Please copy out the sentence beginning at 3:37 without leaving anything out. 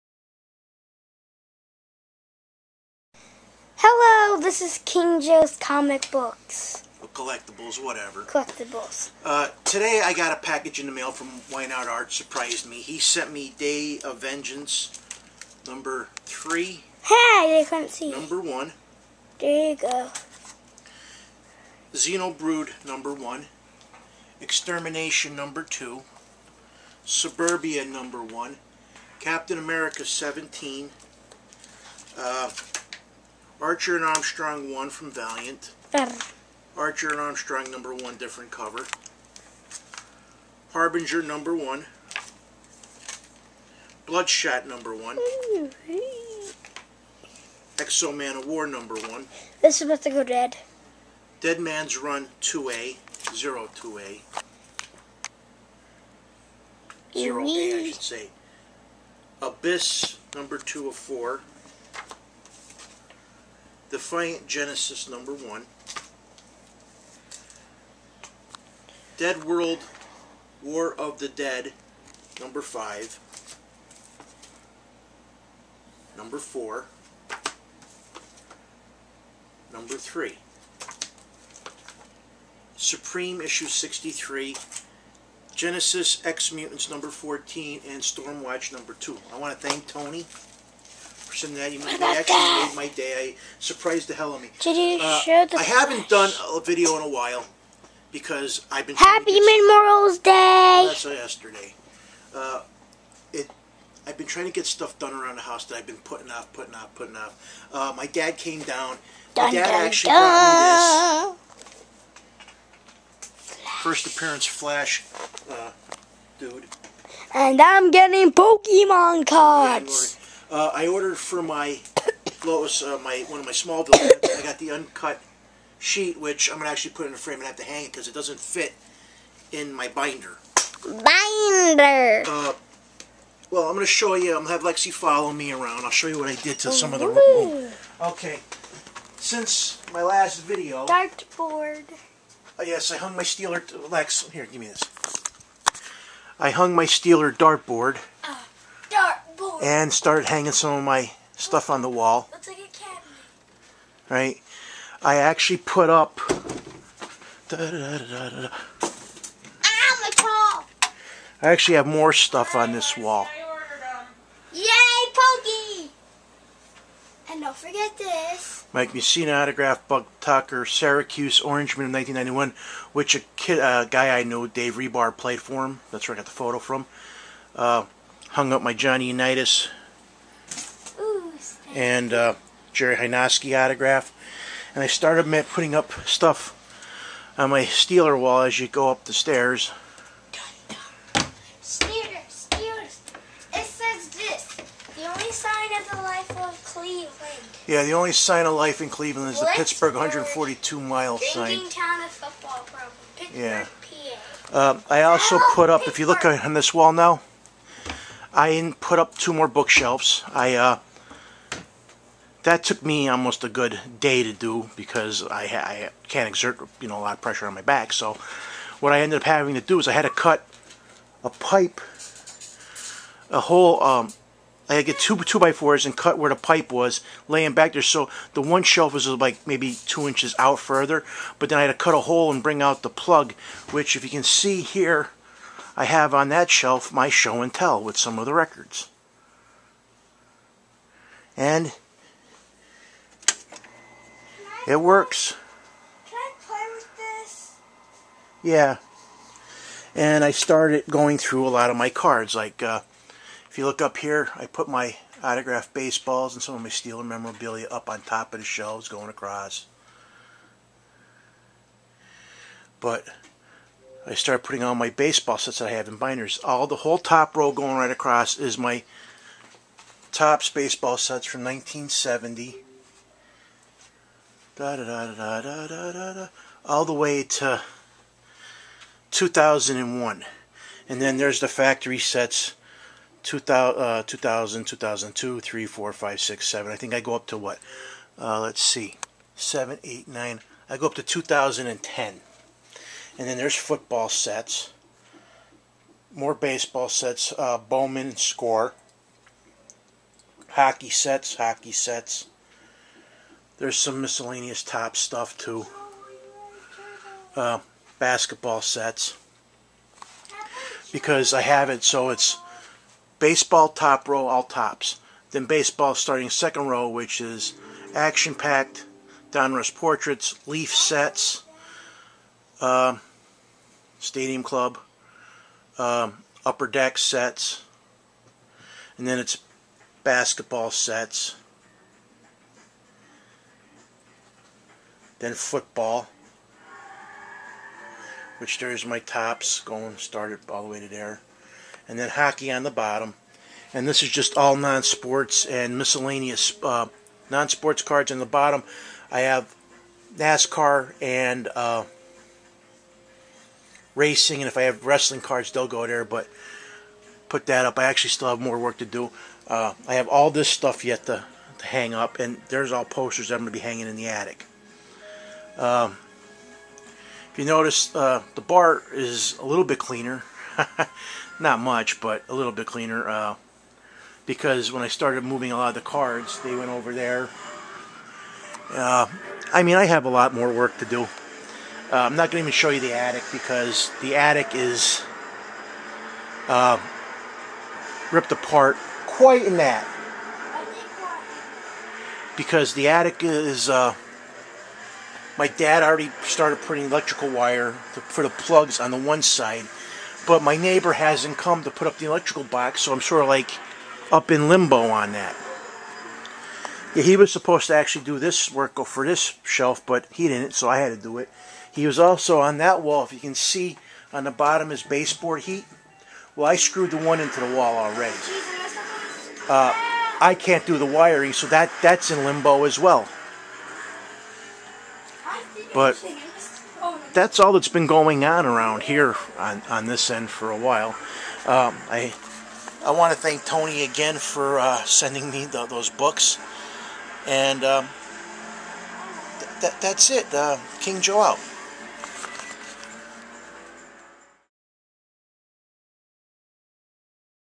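So what I ended up having to do is I had to cut a pipe, a whole.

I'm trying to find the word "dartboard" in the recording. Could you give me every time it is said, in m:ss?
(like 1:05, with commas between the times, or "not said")
2:20, 2:27.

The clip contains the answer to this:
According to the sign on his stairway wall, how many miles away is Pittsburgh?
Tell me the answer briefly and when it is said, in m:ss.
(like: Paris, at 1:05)
142, at 3:19.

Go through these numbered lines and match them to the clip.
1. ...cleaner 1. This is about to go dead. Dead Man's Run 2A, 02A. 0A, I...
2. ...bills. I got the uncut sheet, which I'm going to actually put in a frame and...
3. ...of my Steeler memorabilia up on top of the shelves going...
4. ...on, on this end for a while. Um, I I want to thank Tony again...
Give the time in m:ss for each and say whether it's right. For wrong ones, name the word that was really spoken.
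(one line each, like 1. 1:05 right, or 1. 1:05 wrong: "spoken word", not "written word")
1. 0:48 wrong: "number", not "cleaner"
2. 2:03 right
3. 4:16 right
4. 7:09 right.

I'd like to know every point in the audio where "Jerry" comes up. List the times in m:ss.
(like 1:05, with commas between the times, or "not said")
3:02.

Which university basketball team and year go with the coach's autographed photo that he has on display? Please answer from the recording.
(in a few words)
Syracuse, 1991.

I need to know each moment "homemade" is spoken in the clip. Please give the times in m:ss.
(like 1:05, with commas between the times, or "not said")
not said.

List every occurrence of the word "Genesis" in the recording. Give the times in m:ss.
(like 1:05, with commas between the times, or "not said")
1:04, 1:25.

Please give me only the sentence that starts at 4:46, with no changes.
I think I go up to what?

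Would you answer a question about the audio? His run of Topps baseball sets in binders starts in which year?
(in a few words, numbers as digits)
1970.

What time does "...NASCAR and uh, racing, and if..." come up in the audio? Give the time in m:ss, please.
5:50.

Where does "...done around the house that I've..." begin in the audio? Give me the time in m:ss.
1:44.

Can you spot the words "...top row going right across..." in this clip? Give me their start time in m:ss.
4:26.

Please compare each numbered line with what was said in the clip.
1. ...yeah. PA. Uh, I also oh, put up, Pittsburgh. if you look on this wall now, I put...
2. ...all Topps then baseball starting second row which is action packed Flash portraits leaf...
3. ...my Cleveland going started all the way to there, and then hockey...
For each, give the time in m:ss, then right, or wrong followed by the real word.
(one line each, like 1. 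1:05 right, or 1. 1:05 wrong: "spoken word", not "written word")
1. 3:23 right
2. 5:14 wrong: "Donruss", not "Flash"
3. 5:38 wrong: "Topps", not "Cleveland".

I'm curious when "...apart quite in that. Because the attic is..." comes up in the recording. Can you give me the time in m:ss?
6:28.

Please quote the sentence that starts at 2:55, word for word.
That's where I got the photo from.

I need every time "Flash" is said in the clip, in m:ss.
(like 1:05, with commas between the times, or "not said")
1:54.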